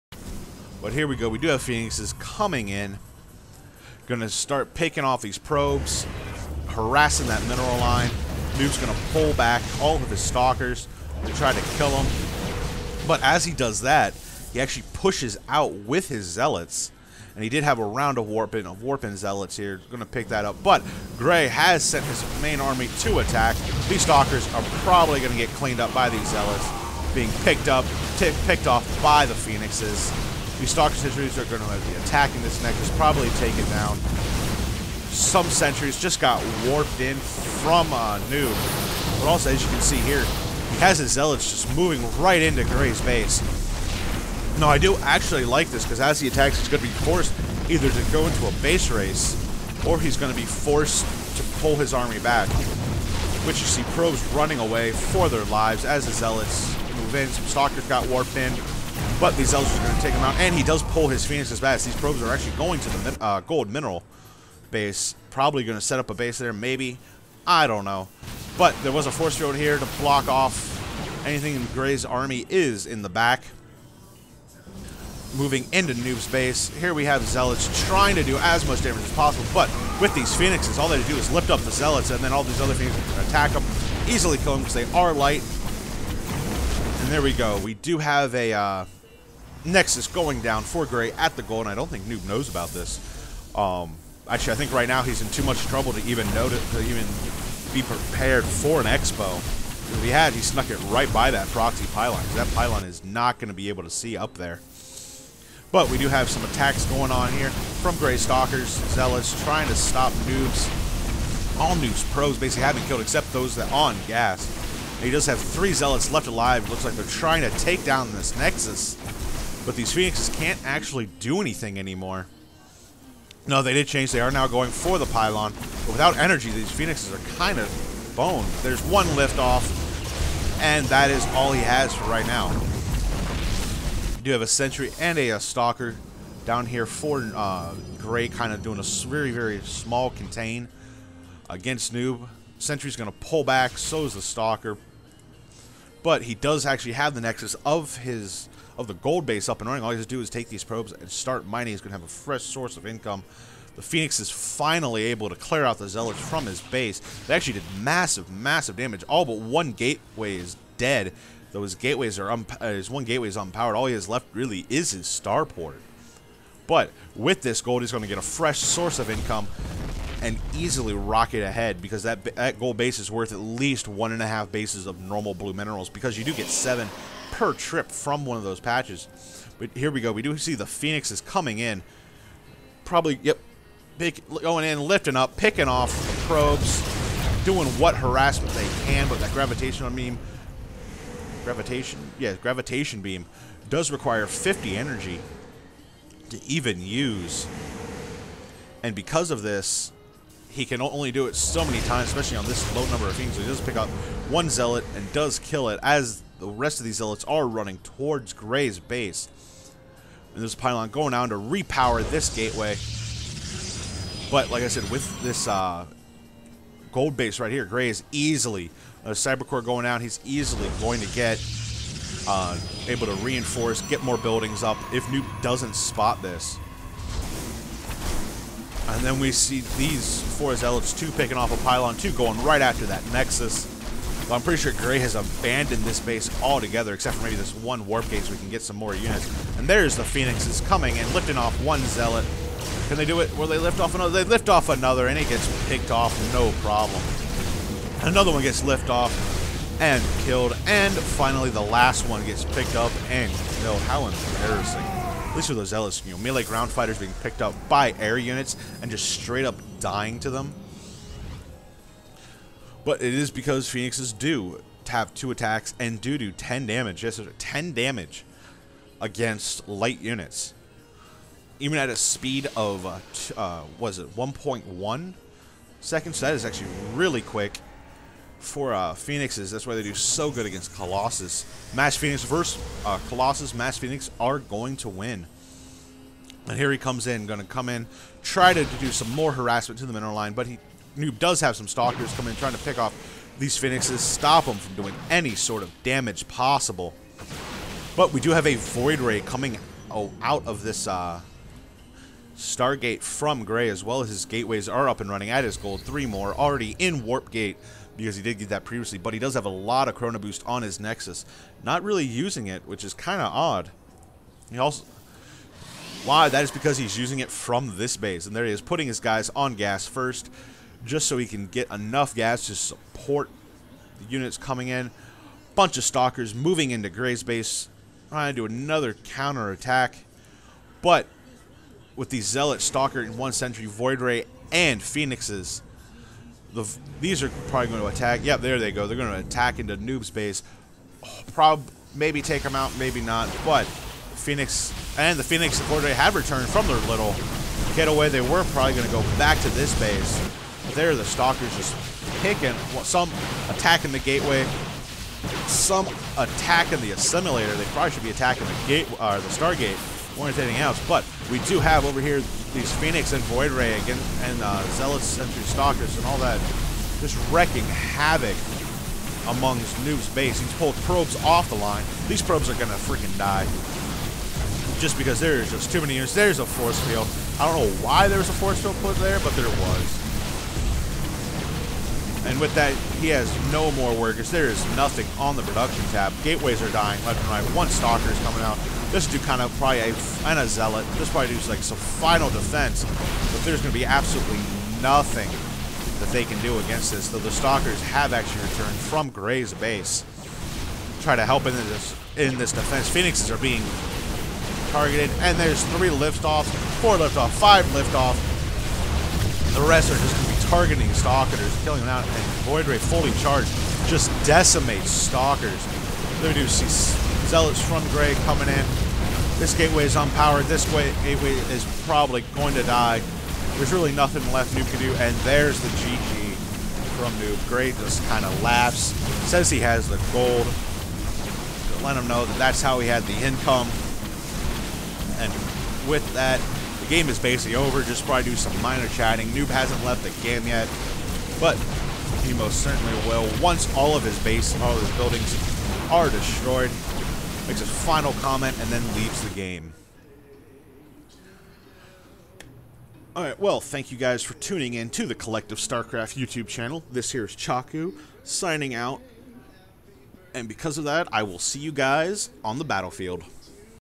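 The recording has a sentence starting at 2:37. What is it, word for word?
They actually did massive, massive damage.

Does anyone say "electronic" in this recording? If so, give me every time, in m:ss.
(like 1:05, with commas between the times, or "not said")
not said.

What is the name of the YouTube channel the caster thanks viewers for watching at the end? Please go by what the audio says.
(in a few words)
Collective StarCraft.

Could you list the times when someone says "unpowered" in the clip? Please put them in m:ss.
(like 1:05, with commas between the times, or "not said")
2:43, 6:59.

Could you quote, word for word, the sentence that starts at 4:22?
But it is because Phoenixes do have two attacks and do do 10 damage.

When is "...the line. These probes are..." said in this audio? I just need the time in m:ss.
6:11.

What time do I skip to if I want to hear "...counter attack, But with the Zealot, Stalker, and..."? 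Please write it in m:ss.
5:28.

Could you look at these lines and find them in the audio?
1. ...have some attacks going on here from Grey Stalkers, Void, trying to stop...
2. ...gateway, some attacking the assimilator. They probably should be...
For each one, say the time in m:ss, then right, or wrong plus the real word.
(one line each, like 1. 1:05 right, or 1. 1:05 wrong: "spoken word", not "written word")
1. 1:46 wrong: "Zealots", not "Void"
2. 5:53 right.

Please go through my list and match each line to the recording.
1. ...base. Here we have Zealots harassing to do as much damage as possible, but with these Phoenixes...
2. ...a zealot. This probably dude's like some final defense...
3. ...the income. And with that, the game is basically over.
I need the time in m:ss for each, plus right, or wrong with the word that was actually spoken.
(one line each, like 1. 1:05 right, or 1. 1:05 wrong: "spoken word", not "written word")
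1. 1:16 wrong: "trying", not "harassing"
2. 6:30 right
3. 7:13 right.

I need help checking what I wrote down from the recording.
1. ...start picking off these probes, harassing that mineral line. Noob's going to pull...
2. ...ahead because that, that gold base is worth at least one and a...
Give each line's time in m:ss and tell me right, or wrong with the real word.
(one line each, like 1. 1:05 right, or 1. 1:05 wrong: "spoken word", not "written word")
1. 0:04 right
2. 2:51 right.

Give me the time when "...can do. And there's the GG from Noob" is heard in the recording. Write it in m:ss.
7:04.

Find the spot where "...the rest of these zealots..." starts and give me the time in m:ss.
3:26.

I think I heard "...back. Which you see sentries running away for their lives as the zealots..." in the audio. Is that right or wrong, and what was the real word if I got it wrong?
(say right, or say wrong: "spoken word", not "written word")
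wrong: "probes", not "sentries".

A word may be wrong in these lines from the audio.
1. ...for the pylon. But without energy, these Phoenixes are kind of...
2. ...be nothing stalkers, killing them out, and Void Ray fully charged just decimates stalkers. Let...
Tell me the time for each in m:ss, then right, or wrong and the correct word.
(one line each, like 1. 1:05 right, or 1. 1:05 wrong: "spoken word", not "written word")
1. 2:04 right
2. 6:50 wrong: "targeting", not "nothing".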